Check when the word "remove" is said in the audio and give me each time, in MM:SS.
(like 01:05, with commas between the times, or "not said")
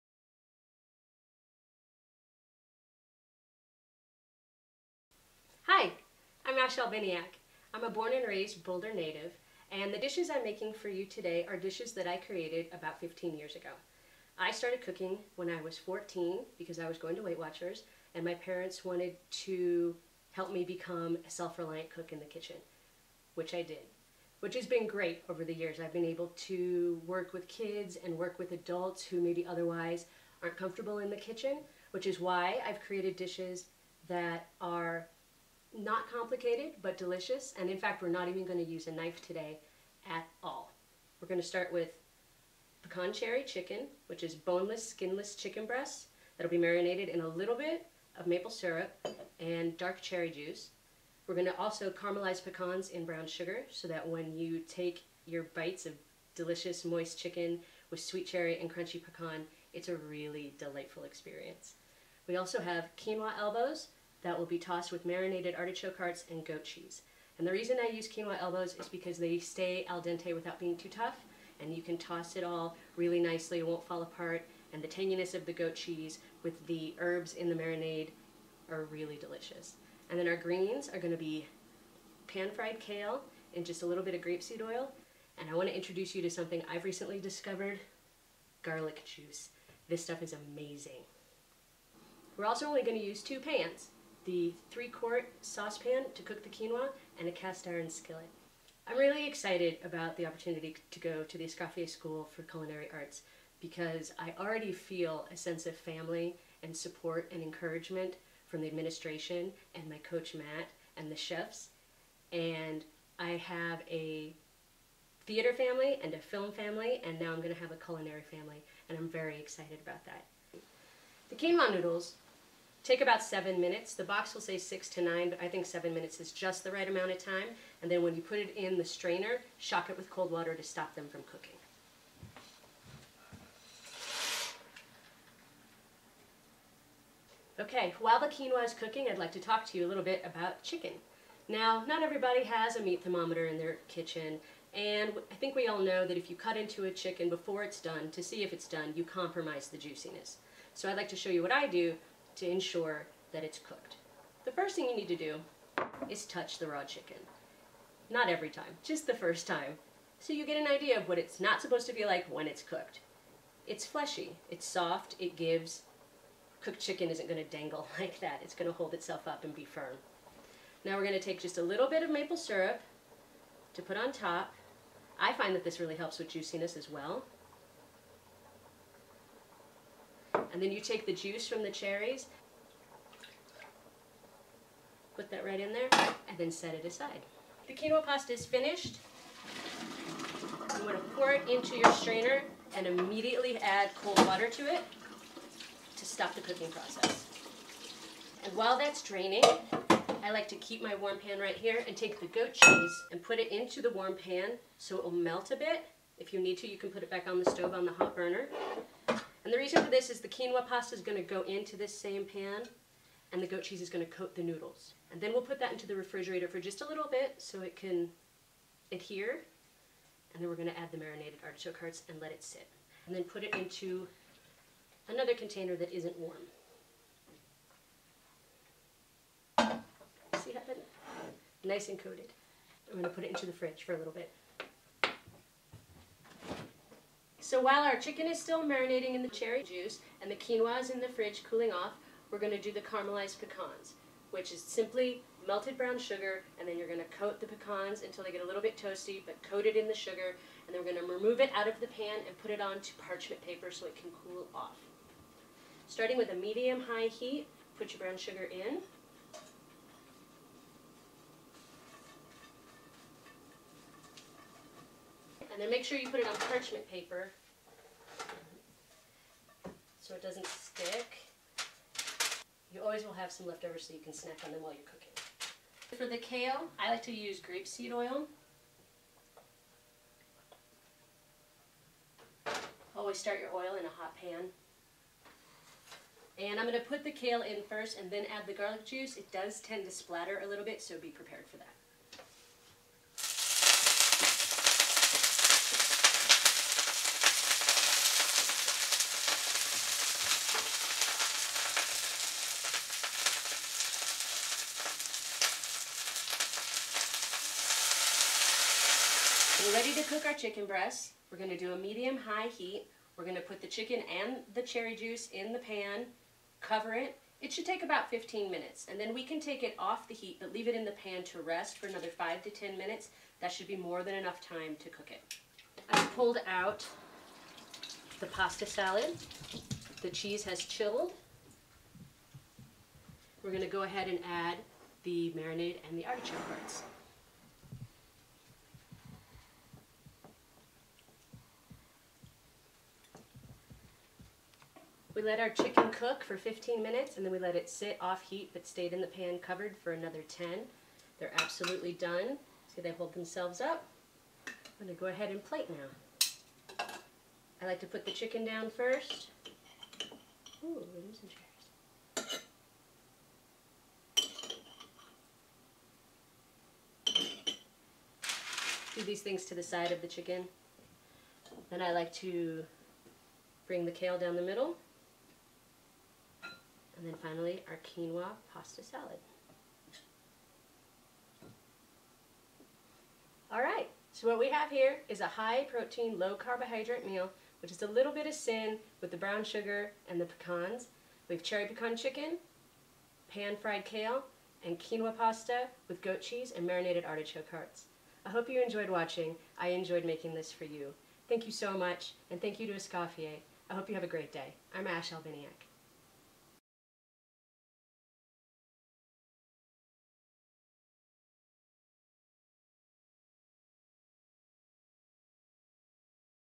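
04:11.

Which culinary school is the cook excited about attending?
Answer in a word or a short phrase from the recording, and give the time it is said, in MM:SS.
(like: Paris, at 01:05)
Escoffier School for Culinary Arts, at 01:41.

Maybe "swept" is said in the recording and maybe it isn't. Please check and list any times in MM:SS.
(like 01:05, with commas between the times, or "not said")
not said.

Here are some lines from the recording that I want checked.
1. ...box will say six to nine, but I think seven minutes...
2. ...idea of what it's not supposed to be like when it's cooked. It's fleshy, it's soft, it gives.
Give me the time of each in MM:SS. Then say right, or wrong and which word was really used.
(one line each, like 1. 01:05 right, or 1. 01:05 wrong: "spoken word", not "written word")
1. 02:04 right
2. 02:40 right.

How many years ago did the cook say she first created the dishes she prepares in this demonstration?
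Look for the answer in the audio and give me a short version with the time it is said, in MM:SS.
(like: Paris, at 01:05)
15, at 00:12.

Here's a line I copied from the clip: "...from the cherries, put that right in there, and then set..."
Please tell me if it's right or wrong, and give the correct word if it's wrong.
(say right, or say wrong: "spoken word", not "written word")
right.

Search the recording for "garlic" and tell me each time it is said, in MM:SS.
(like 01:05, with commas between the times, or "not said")
01:28, 04:48.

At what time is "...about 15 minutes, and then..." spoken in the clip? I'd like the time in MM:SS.
05:17.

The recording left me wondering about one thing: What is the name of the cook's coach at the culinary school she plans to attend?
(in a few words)
Matt.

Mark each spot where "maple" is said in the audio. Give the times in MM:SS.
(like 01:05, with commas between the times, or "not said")
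00:48, 02:52.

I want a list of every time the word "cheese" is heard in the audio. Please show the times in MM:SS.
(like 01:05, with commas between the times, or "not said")
01:06, 01:15, 03:22, 03:33, 05:30, 06:36.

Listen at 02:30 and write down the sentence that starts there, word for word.
So I'd like to show you what I do to ensure that it's cooked.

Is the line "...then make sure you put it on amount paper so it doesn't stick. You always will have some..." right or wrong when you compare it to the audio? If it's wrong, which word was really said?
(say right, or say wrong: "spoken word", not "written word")
wrong: "parchment", not "amount".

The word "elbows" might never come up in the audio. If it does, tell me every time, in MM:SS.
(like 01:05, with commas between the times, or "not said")
01:03, 01:08.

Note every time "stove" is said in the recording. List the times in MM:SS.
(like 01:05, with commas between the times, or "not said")
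03:27.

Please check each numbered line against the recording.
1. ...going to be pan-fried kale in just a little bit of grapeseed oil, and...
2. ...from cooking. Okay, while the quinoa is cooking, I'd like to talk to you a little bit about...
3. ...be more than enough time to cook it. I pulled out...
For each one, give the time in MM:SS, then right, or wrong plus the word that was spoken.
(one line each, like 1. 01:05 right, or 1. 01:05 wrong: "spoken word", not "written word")
1. 01:20 right
2. 02:11 right
3. 05:23 right.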